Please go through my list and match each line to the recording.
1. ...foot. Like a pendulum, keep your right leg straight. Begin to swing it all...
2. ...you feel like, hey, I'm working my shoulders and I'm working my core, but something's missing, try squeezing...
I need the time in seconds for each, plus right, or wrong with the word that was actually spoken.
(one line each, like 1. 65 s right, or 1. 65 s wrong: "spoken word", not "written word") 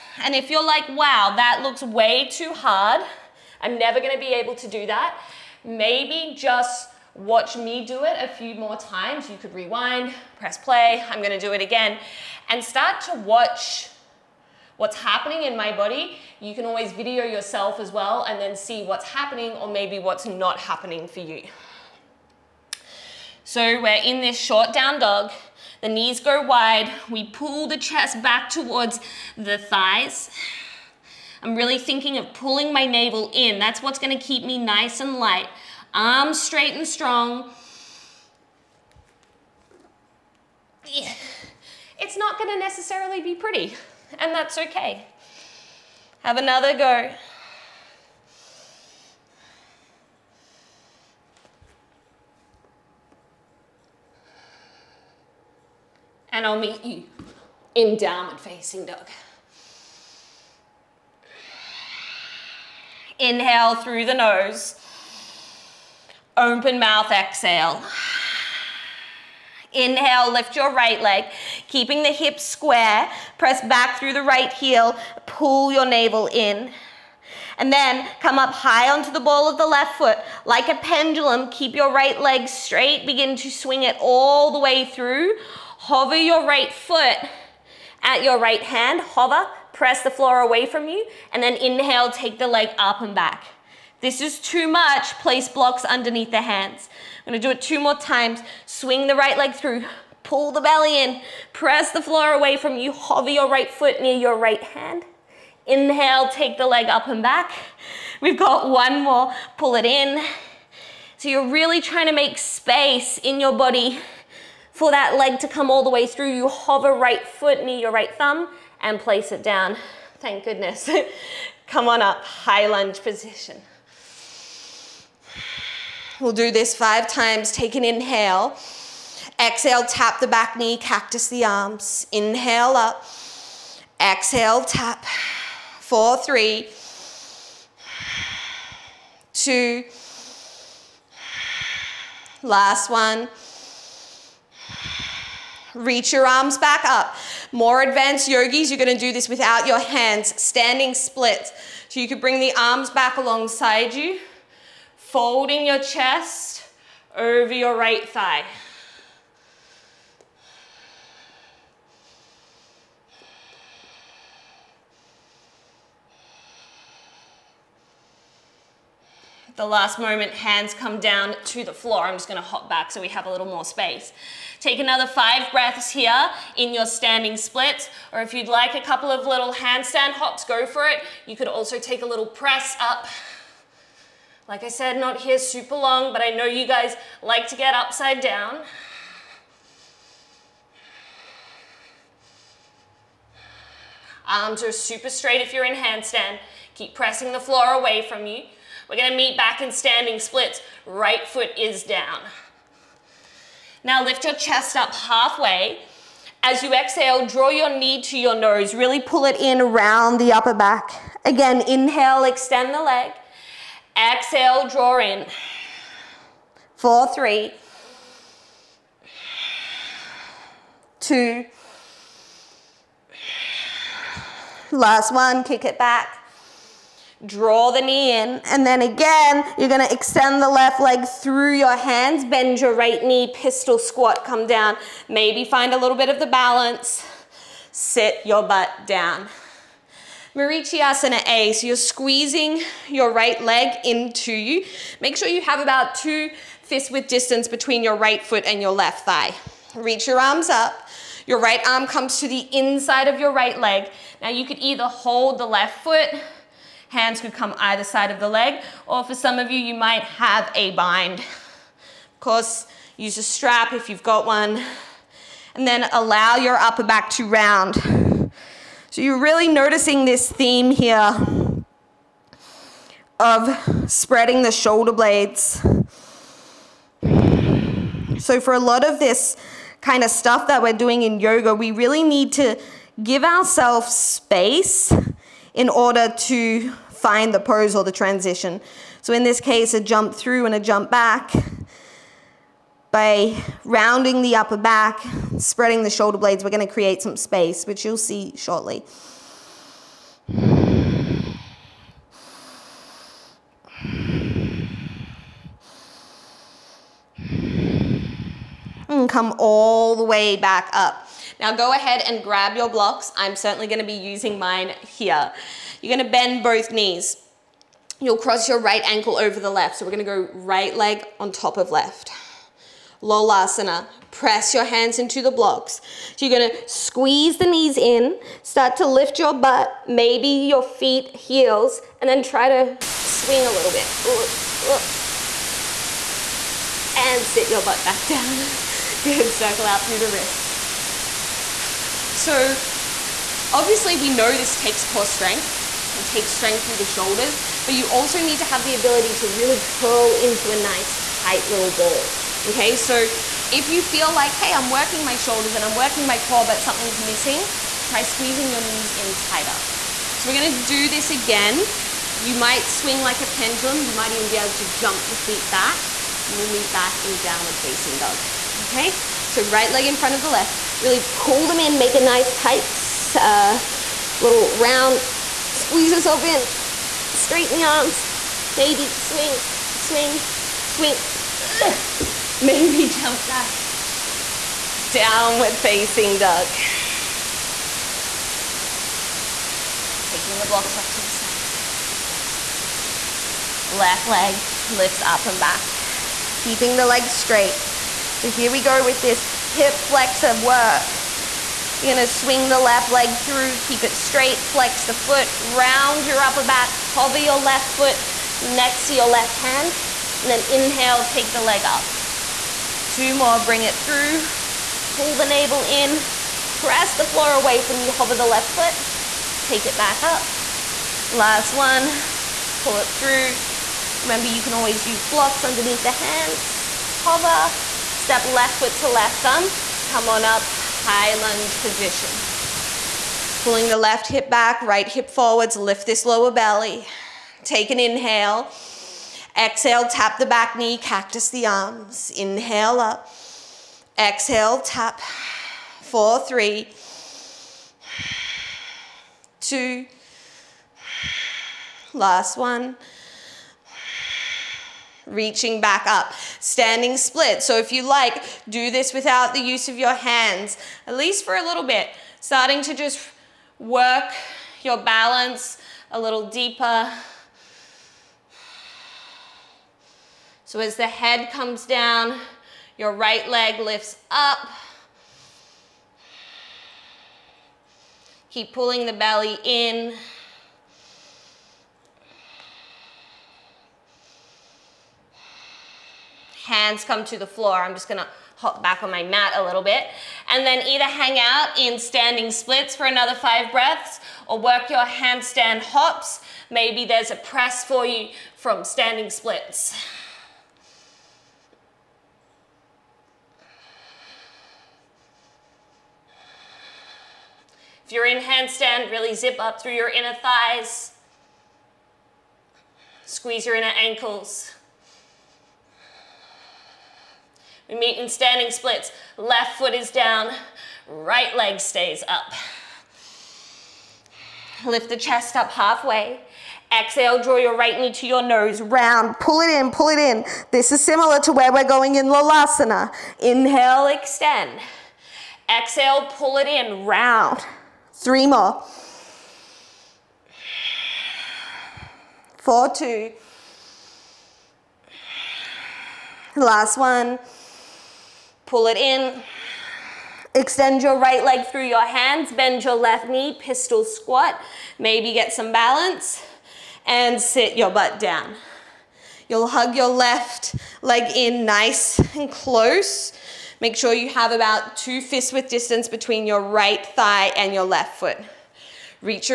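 1. 79 s right
2. 353 s right.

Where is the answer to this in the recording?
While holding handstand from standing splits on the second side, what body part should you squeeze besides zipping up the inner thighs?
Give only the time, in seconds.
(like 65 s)
513 s.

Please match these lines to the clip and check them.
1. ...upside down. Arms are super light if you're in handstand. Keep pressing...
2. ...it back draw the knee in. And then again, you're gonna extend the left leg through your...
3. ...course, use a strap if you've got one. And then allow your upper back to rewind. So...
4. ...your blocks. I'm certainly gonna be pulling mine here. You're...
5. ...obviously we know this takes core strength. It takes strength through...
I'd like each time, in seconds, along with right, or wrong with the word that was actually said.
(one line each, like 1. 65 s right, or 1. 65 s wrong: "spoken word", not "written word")
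1. 187 s wrong: "straight", not "light"
2. 225 s right
3. 262 s wrong: "round", not "rewind"
4. 312 s wrong: "using", not "pulling"
5. 343 s right.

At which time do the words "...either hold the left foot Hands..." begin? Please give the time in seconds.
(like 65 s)
254 s.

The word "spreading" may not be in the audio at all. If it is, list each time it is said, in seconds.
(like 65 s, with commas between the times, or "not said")
273 s, 295 s.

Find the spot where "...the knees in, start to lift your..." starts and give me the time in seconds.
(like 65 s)
327 s.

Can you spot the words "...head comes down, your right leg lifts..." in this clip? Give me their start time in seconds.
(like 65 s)
470 s.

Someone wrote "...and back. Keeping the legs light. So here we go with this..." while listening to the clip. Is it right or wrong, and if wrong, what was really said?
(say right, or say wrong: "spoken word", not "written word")
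wrong: "straight", not "light".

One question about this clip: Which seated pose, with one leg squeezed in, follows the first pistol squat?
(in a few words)
Marichyasana A.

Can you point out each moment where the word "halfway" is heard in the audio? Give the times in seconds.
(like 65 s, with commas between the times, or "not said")
204 s, 525 s.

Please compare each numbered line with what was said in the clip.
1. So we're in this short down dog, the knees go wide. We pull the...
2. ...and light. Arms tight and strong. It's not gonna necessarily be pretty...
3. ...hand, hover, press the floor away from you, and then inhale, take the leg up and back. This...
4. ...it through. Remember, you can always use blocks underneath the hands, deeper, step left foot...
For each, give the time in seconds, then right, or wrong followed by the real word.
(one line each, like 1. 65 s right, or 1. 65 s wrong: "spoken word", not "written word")
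1. 23 s right
2. 34 s wrong: "straight", not "tight"
3. 88 s right
4. 422 s wrong: "hover", not "deeper".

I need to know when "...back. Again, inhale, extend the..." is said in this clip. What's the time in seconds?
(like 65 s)
210 s.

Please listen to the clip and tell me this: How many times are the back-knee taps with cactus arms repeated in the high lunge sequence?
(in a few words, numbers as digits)
5.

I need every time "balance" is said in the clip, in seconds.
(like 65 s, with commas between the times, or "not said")
236 s, 464 s, 555 s.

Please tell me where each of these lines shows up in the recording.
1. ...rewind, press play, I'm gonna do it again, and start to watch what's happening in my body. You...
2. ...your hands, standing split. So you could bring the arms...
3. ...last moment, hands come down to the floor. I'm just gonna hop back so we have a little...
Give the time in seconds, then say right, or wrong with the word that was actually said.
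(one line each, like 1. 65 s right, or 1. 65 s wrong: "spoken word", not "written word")
1. 9 s right
2. 149 s right
3. 169 s right.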